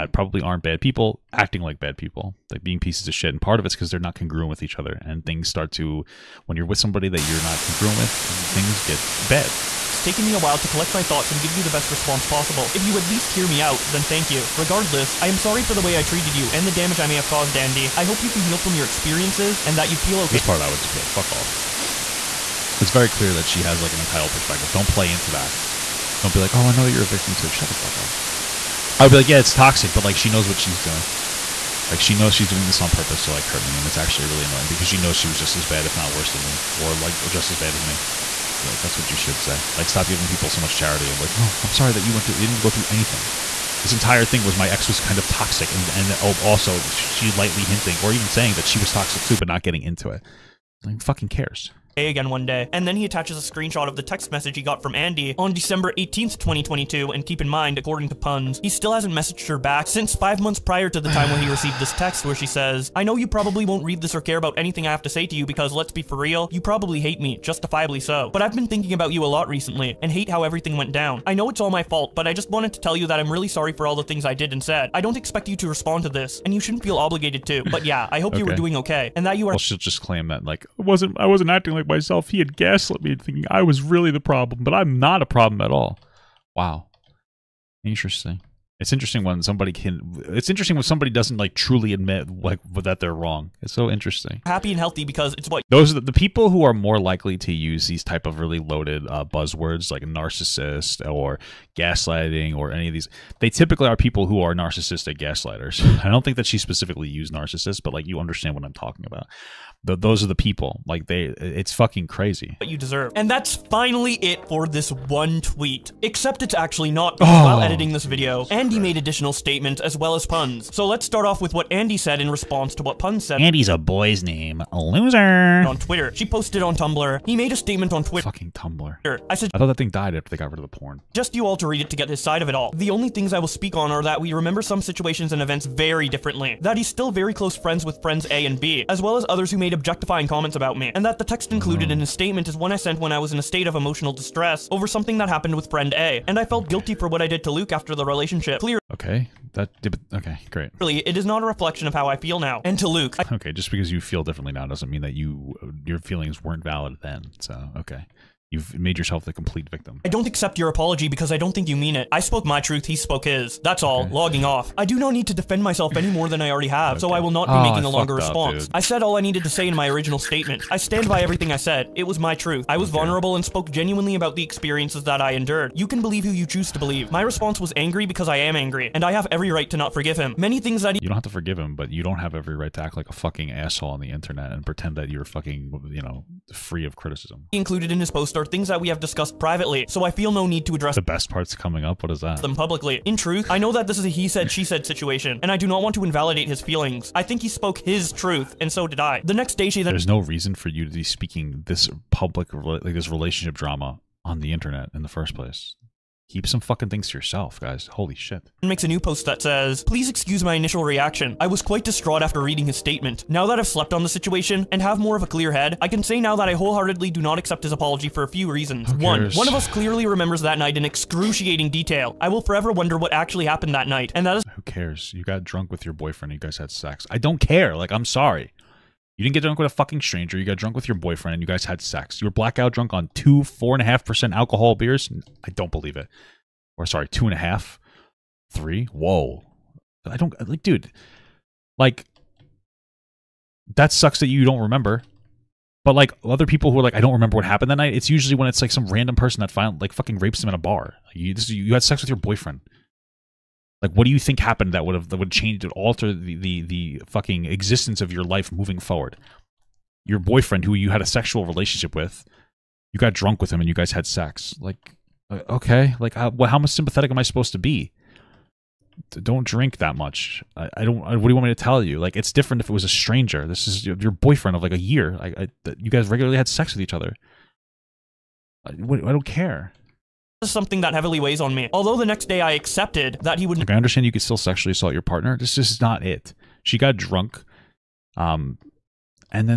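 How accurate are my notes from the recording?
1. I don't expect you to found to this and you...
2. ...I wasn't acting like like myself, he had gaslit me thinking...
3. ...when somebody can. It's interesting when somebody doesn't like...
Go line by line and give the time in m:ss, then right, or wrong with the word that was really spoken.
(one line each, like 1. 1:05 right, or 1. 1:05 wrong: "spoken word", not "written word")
1. 1:14 wrong: "respond", not "found"
2. 1:21 right
3. 1:29 right.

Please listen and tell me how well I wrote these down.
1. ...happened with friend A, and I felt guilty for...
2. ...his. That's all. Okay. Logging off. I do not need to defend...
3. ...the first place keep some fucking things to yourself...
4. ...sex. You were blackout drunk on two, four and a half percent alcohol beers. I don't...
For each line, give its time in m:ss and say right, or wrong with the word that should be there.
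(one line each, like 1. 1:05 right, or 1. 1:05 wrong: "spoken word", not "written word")
1. 2:25 right
2. 2:43 right
3. 3:25 right
4. 3:51 right.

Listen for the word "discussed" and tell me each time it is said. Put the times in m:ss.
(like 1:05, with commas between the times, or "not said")
3:08.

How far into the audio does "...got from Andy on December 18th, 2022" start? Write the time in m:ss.
0:54.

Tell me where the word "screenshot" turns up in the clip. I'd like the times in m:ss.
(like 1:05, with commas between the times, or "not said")
0:53.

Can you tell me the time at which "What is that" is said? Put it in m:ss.
3:12.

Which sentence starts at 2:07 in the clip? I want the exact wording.
He made a statement on Twitter.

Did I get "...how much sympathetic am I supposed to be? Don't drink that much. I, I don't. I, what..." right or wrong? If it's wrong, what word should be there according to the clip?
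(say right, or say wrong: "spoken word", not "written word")
right.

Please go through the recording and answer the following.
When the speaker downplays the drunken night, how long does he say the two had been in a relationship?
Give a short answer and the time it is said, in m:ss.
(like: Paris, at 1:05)
a year, at 4:34.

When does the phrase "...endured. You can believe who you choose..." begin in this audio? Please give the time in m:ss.
2:55.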